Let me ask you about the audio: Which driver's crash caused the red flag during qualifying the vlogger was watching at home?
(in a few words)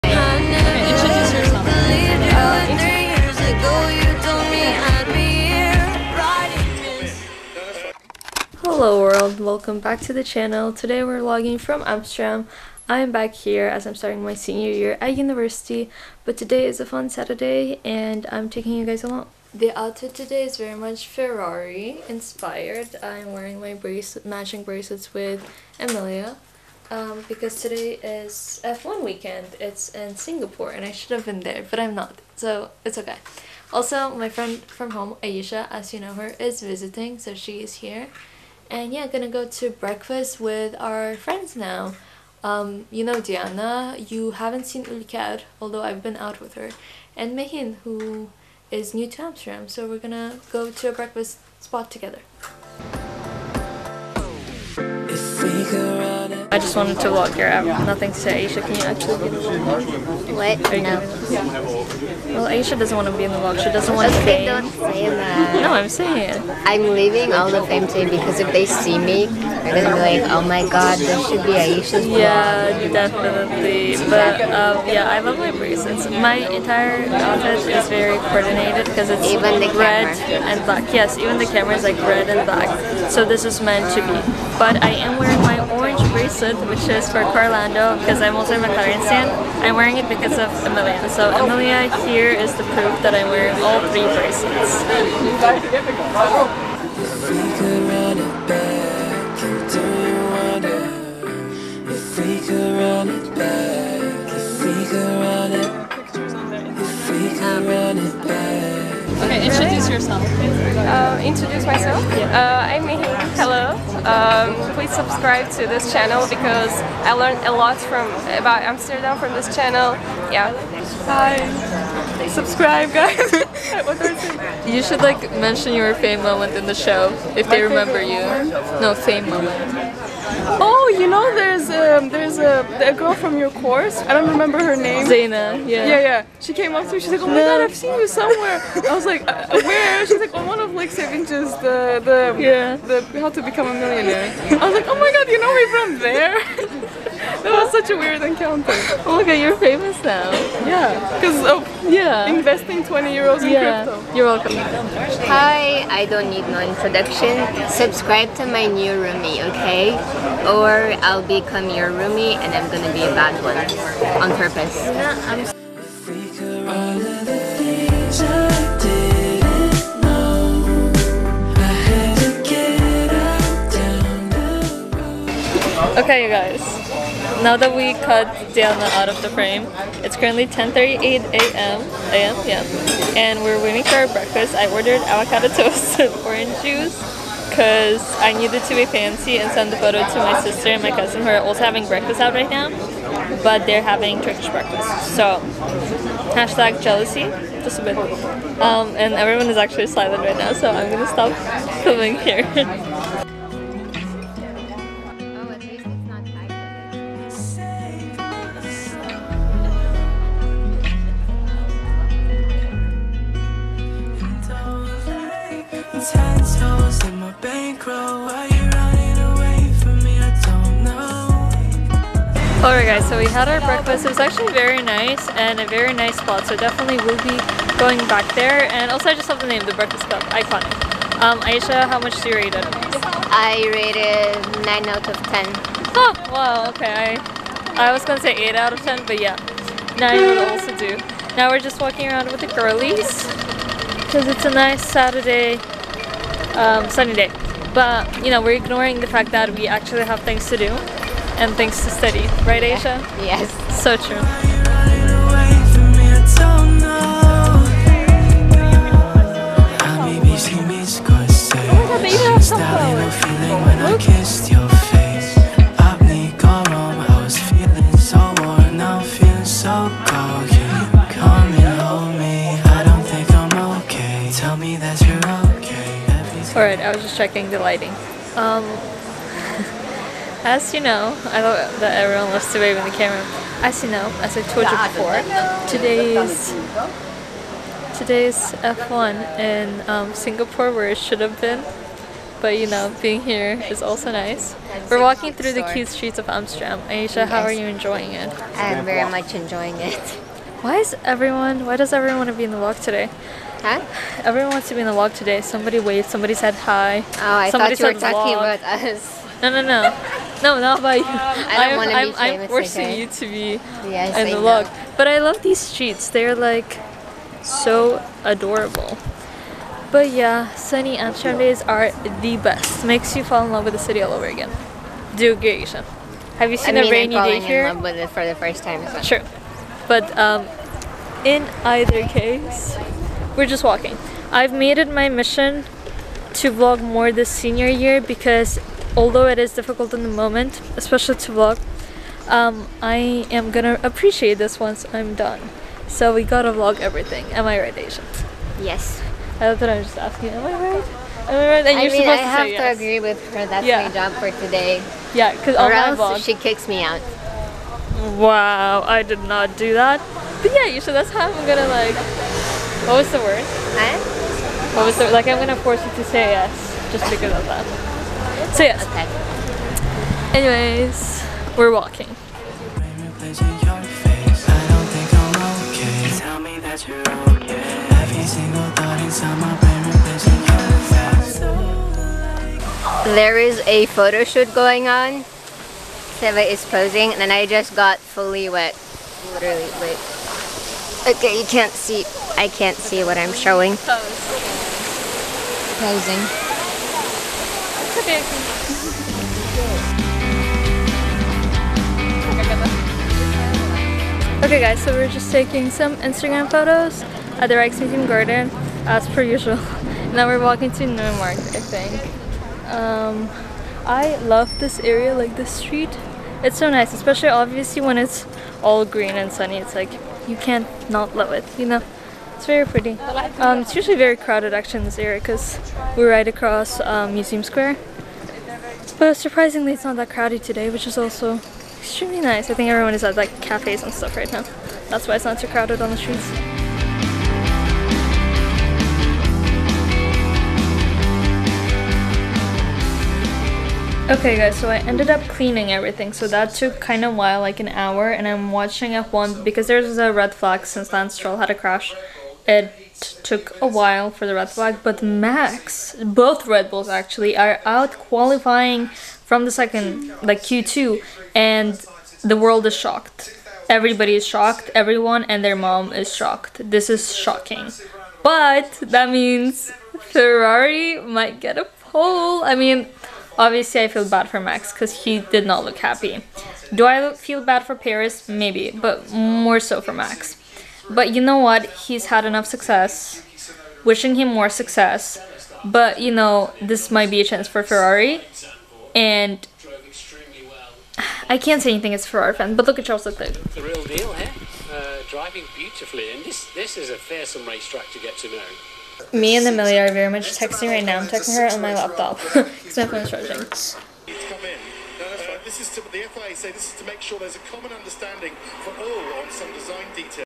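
Lance Stroll.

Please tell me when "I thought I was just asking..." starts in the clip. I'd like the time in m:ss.
5:49.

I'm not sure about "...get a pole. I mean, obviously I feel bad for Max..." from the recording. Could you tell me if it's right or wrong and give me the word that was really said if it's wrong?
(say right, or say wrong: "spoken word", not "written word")
right.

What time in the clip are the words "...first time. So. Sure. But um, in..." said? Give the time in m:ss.
5:28.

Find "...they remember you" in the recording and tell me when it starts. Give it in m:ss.
2:07.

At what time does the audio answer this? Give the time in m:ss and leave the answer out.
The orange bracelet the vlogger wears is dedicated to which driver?
1:27.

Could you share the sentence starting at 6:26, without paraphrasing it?
Seva is posing and I just got fully wet.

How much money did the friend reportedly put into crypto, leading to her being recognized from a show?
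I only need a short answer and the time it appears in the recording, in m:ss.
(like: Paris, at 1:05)
20 euros, at 2:32.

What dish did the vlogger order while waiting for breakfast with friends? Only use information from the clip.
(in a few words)
avocado toast.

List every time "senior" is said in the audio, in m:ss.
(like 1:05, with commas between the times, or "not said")
0:14, 5:37.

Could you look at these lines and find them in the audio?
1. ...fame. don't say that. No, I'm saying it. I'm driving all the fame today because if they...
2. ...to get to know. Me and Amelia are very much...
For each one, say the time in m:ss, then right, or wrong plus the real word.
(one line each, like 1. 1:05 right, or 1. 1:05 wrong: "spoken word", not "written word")
1. 1:04 wrong: "leaving", not "driving"
2. 8:17 right.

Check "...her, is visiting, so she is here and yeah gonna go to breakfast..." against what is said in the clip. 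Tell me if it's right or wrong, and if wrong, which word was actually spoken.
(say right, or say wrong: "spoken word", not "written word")
right.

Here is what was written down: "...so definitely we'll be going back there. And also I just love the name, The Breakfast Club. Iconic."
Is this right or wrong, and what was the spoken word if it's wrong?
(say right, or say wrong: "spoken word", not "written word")
right.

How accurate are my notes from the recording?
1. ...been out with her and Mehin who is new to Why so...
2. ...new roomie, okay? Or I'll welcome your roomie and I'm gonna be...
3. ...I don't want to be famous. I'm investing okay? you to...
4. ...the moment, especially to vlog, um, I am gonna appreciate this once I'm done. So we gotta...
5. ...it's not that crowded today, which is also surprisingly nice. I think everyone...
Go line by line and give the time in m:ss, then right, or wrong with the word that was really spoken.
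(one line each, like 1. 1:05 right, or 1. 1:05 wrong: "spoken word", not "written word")
1. 0:46 wrong: "Amsterdam", not "Why"
2. 2:38 wrong: "become", not "welcome"
3. 5:11 wrong: "forcing", not "investing"
4. 5:40 right
5. 7:09 wrong: "extremely", not "surprisingly".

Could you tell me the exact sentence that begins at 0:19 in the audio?
The outfit today is very much Ferrari inspired.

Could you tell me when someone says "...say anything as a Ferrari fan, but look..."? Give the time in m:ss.
8:11.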